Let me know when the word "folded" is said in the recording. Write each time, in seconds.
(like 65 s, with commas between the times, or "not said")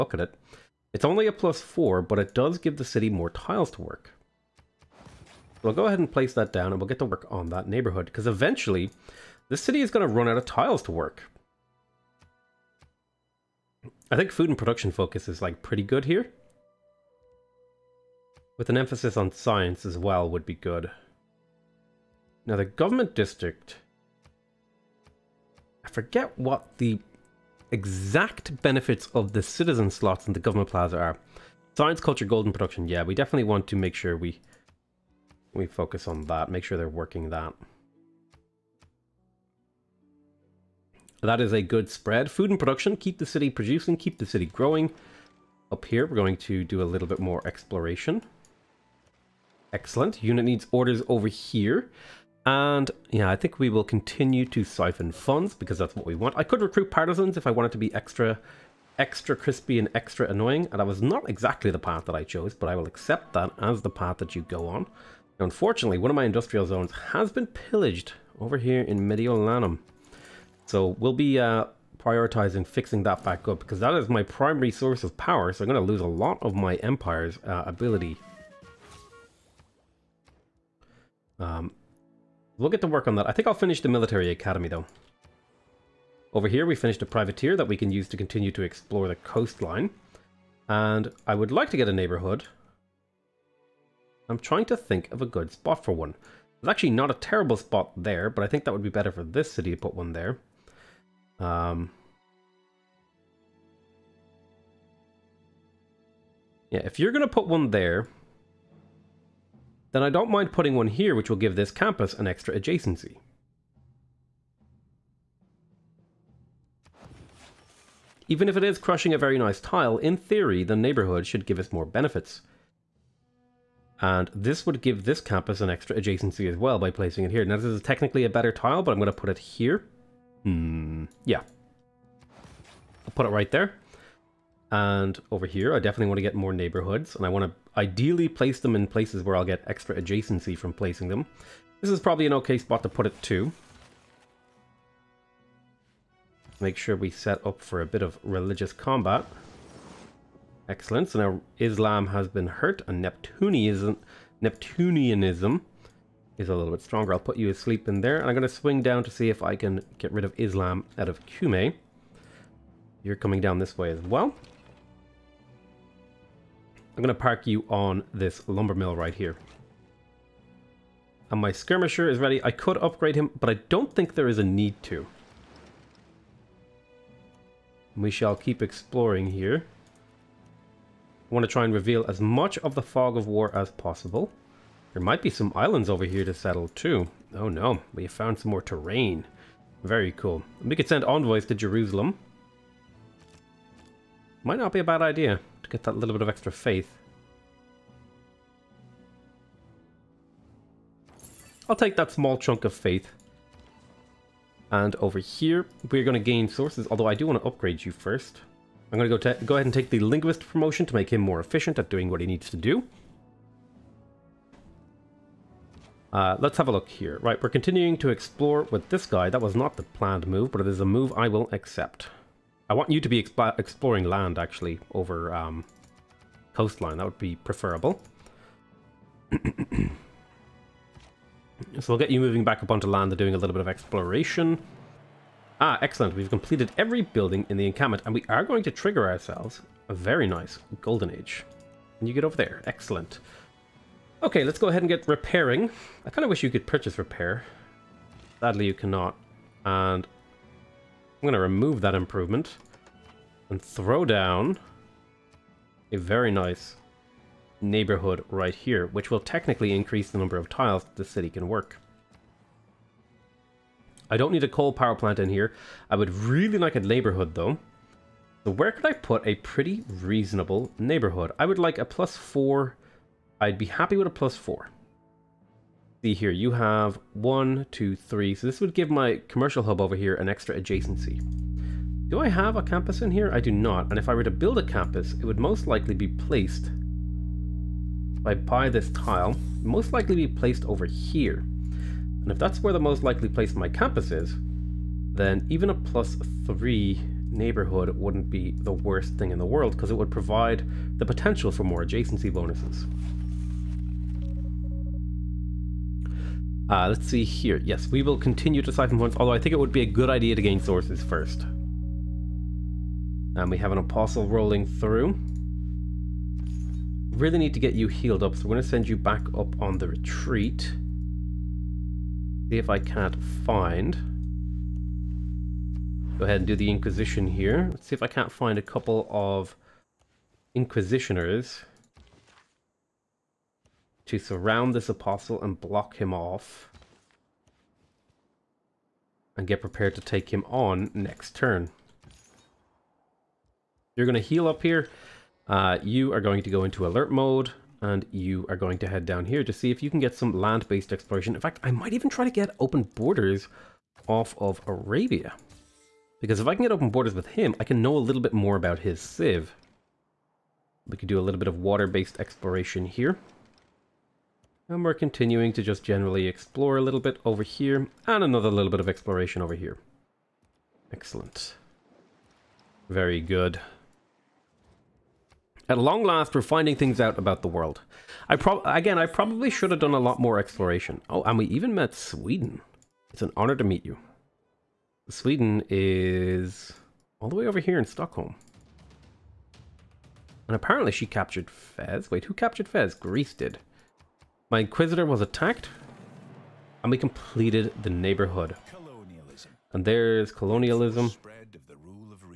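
not said.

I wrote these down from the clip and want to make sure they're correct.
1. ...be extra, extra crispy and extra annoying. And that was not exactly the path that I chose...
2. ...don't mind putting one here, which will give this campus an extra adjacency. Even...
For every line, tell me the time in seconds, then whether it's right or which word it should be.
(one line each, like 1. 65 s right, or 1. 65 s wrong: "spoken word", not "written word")
1. 57 s right
2. 110 s right.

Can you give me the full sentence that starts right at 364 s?
And we're continuing to just generally explore a little bit over here, and another little bit of exploration over here.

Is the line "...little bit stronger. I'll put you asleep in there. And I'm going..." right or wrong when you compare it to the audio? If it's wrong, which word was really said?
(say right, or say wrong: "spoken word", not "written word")
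right.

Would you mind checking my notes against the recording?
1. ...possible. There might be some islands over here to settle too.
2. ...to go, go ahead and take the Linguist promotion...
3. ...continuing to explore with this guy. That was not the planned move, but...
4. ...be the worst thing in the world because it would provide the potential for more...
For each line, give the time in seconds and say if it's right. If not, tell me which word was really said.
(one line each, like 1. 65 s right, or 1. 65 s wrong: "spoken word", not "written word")
1. 183 s right
2. 209 s right
3. 217 s right
4. 298 s right.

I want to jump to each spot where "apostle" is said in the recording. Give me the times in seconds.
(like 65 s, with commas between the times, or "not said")
313 s, 334 s.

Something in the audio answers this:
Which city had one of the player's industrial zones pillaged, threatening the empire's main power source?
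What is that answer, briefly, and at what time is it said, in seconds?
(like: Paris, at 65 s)
Mediolanum, at 68 s.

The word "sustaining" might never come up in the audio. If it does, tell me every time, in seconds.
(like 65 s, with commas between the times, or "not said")
not said.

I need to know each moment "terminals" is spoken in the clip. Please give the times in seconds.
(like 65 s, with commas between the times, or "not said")
not said.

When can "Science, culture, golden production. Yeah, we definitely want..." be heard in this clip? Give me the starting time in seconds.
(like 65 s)
31 s.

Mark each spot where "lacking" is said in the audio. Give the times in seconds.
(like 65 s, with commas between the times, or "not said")
not said.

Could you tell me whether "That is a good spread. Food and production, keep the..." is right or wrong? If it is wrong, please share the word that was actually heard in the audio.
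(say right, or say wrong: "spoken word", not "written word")
right.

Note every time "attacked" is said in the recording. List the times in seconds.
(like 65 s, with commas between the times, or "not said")
395 s.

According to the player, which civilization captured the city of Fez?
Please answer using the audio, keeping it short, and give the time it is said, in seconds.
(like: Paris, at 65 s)
Greece, at 392 s.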